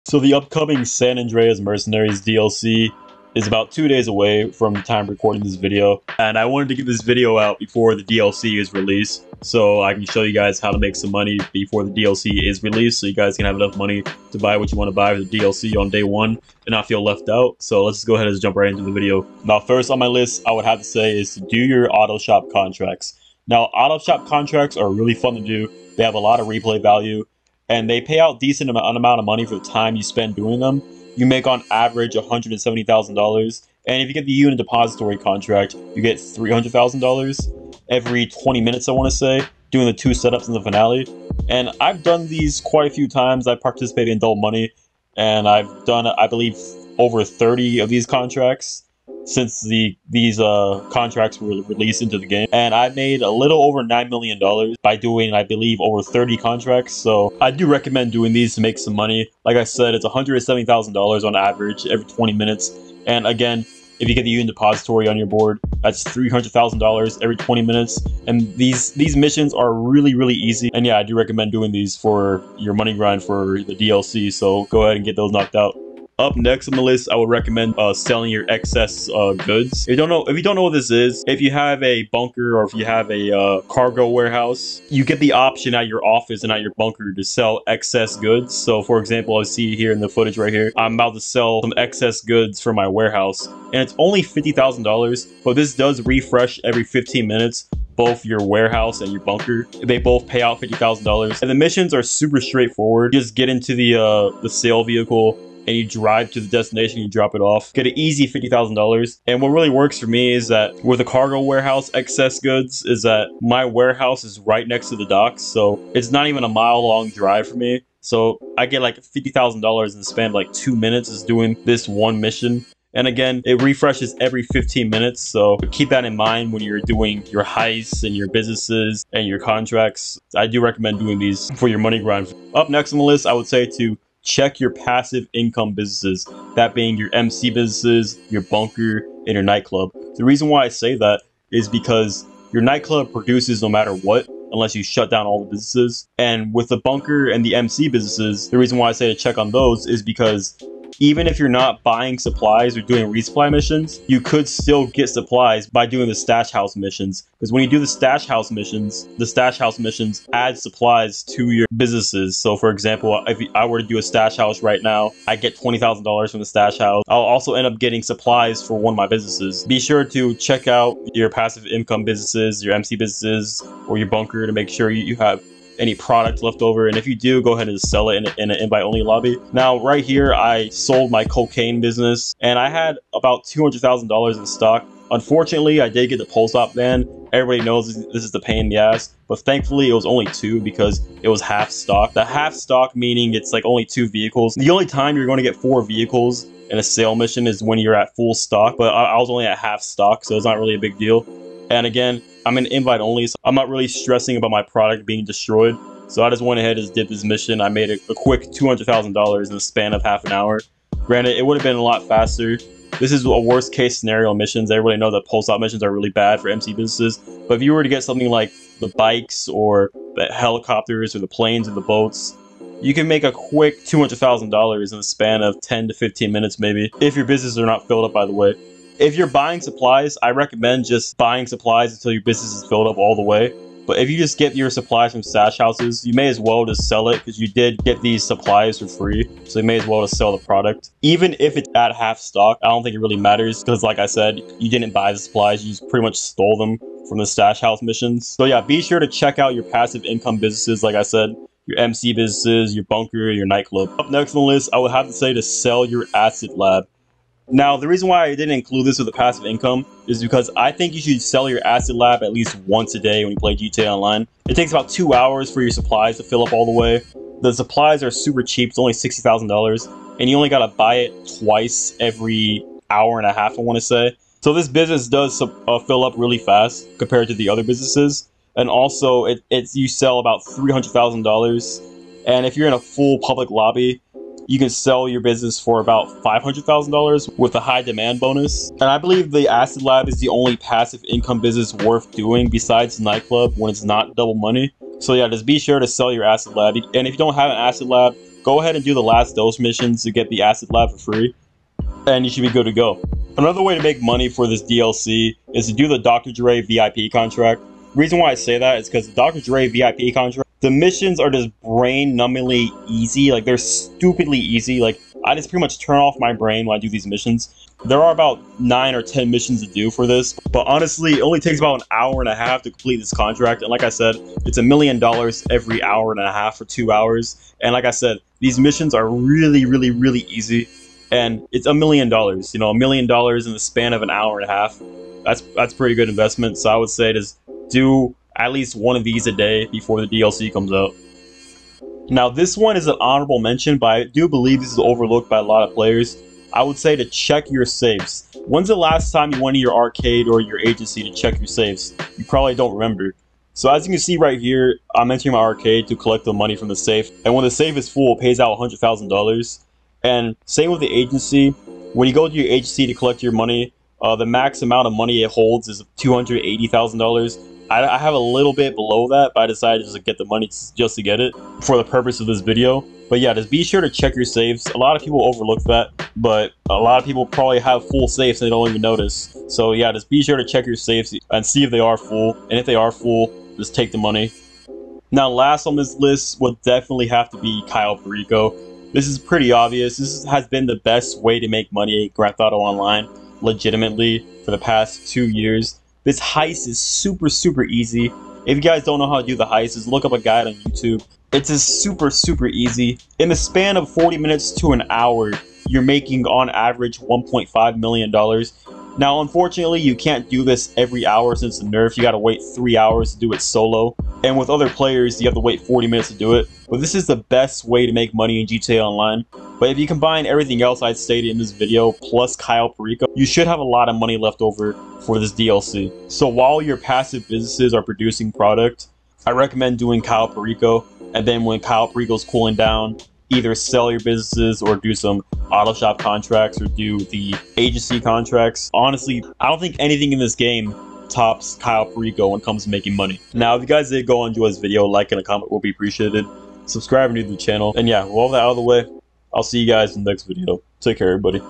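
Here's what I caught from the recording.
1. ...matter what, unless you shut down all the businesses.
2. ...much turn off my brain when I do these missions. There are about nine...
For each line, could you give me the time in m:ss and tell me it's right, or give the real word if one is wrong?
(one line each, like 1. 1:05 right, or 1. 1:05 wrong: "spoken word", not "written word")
1. 2:23 right
2. 5:15 right.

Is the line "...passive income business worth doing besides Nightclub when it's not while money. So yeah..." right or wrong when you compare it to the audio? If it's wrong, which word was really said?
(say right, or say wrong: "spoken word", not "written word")
wrong: "double", not "while".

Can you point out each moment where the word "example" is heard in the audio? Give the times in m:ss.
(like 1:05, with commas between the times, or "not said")
1:28, 2:42.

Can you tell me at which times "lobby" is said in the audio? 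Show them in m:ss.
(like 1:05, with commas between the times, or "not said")
2:59, 4:43.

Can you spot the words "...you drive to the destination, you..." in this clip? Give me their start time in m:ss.
1:45.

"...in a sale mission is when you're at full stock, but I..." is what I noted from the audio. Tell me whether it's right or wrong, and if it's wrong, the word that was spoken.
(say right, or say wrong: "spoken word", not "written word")
right.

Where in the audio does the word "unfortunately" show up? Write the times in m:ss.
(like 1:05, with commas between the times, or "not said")
3:05, 6:49.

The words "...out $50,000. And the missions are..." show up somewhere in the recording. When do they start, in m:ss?
1:40.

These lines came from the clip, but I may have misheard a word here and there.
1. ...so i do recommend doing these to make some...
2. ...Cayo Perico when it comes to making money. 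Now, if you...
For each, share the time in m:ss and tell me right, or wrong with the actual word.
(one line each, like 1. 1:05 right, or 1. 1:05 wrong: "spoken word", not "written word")
1. 0:56 right
2. 7:21 right.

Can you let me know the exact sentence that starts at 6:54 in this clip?
And with other players, you have to wait 40 minutes to do it.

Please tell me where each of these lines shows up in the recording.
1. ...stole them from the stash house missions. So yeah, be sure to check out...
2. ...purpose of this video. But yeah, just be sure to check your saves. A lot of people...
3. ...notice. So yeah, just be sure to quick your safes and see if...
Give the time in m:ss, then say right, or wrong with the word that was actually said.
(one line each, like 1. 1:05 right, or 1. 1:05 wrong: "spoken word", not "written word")
1. 4:06 right
2. 6:11 right
3. 6:18 wrong: "check", not "quick".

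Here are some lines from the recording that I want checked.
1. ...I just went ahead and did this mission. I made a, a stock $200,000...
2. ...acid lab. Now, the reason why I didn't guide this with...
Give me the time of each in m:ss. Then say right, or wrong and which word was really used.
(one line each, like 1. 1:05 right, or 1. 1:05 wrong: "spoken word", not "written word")
1. 3:26 wrong: "quick", not "stock"
2. 4:16 wrong: "include", not "guide".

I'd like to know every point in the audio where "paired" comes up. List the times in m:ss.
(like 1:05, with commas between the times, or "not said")
not said.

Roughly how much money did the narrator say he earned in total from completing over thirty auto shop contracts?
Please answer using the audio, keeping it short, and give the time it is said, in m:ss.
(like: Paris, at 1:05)
9 million dollars, at 0:53.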